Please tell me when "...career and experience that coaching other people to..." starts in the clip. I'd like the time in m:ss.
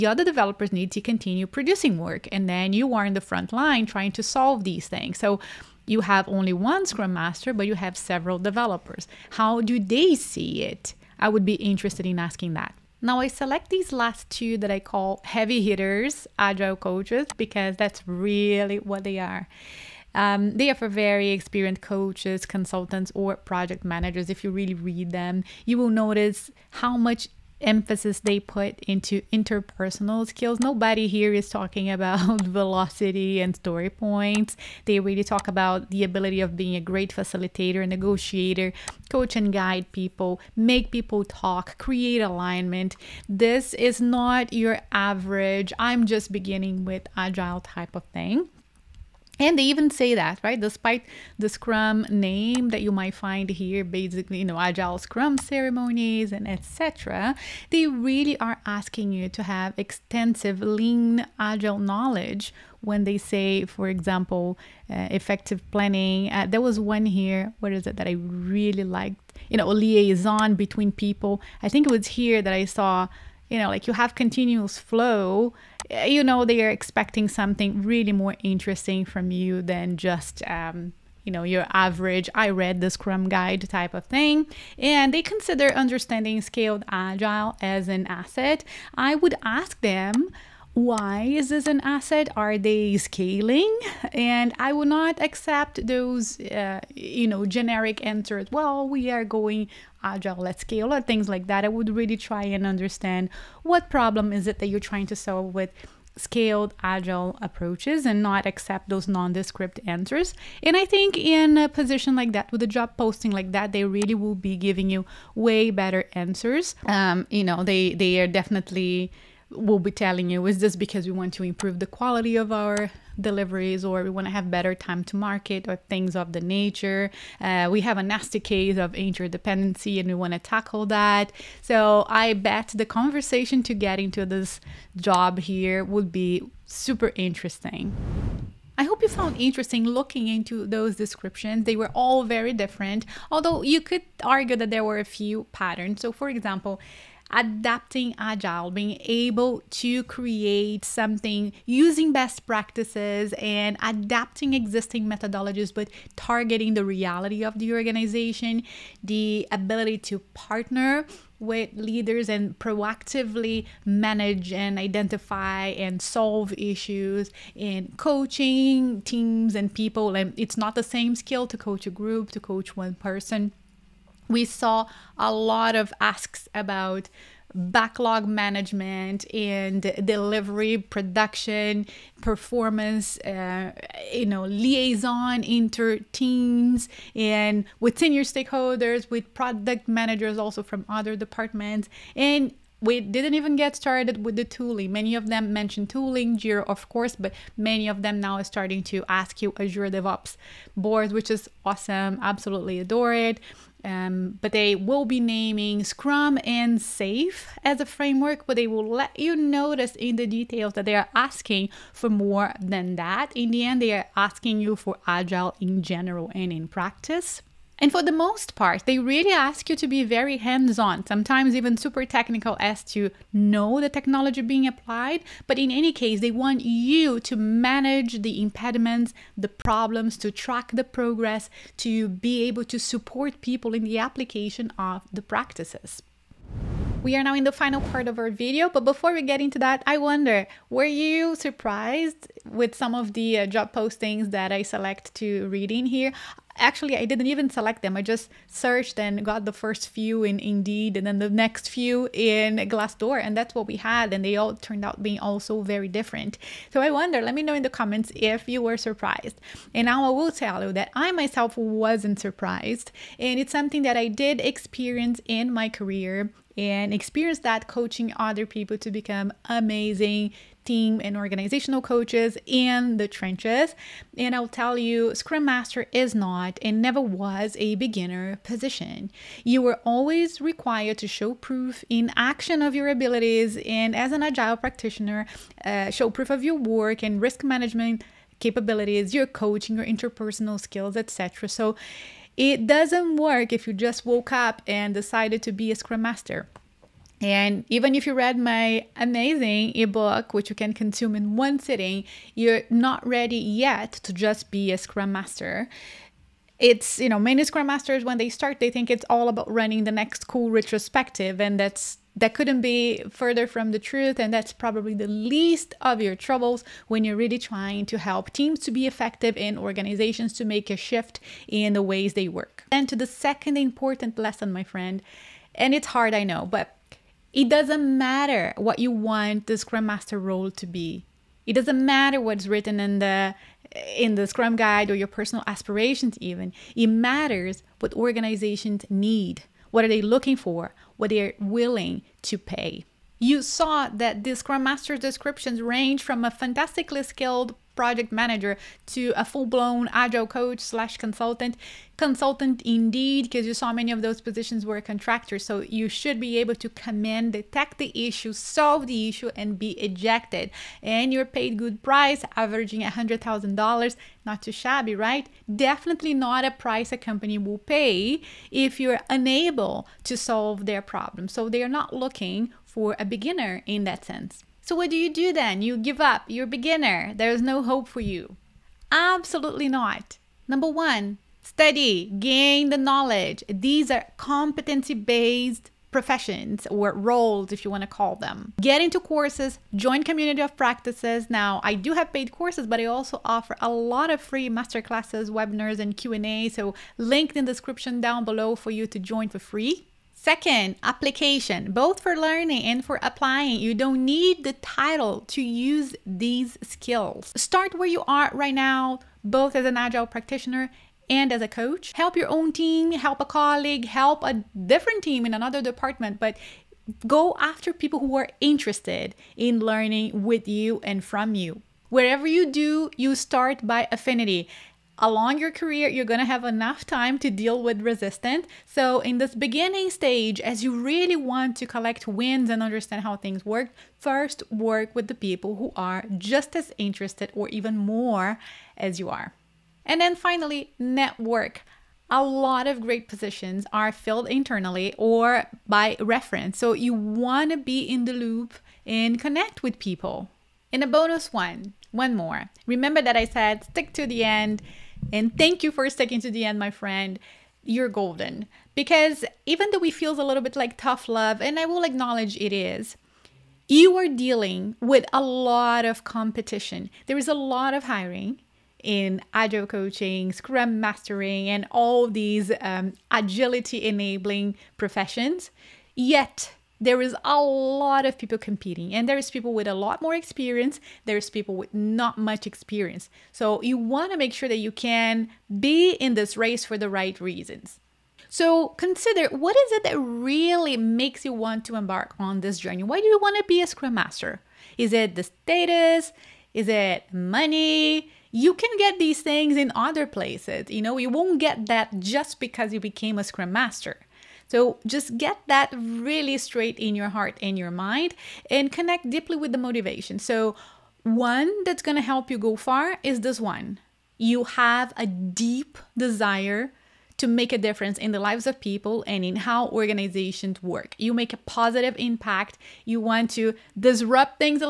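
4:25.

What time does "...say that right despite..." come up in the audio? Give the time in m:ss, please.
0:49.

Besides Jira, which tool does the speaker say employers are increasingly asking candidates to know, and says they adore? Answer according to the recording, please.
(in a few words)
Azure DevOps boards.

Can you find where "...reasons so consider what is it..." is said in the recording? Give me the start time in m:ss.
8:07.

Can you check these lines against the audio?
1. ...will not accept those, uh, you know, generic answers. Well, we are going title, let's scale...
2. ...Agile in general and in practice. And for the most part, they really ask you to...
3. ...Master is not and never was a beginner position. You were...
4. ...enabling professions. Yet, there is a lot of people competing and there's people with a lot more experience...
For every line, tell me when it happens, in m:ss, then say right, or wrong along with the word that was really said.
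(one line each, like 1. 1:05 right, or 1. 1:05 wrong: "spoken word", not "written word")
1. 1:34 wrong: "agile", not "title"
2. 3:35 right
3. 4:35 right
4. 7:53 right.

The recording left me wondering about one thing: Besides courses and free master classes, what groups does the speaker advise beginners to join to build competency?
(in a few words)
community of practices.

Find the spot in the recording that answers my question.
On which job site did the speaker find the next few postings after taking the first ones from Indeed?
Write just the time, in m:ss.
4:12.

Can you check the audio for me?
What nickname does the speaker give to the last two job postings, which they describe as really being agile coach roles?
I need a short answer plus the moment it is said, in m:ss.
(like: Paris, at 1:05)
heavy hitters, at 0:15.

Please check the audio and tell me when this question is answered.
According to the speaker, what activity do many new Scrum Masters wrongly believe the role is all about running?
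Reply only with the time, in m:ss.
5:10.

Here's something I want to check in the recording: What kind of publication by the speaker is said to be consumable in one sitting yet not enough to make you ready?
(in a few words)
ebook.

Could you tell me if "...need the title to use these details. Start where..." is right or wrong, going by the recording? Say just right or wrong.
wrong.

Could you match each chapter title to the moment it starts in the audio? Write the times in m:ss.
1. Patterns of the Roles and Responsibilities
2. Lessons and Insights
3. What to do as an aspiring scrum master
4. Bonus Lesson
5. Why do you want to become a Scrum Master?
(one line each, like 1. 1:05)
1. 2:17
2. 3:56
3. 6:14
4. 7:30
5. 8:07.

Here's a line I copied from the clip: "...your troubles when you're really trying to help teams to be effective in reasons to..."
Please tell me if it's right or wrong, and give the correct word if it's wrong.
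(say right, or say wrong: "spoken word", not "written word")
wrong: "organizations", not "reasons".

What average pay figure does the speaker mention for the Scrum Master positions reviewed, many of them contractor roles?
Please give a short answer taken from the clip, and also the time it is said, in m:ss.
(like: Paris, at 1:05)
$100,000, at 6:02.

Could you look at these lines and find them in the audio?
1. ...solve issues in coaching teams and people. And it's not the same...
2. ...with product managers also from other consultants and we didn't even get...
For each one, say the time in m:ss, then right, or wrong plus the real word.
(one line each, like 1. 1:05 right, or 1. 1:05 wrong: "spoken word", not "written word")
1. 2:45 right
2. 3:09 wrong: "departments", not "consultants".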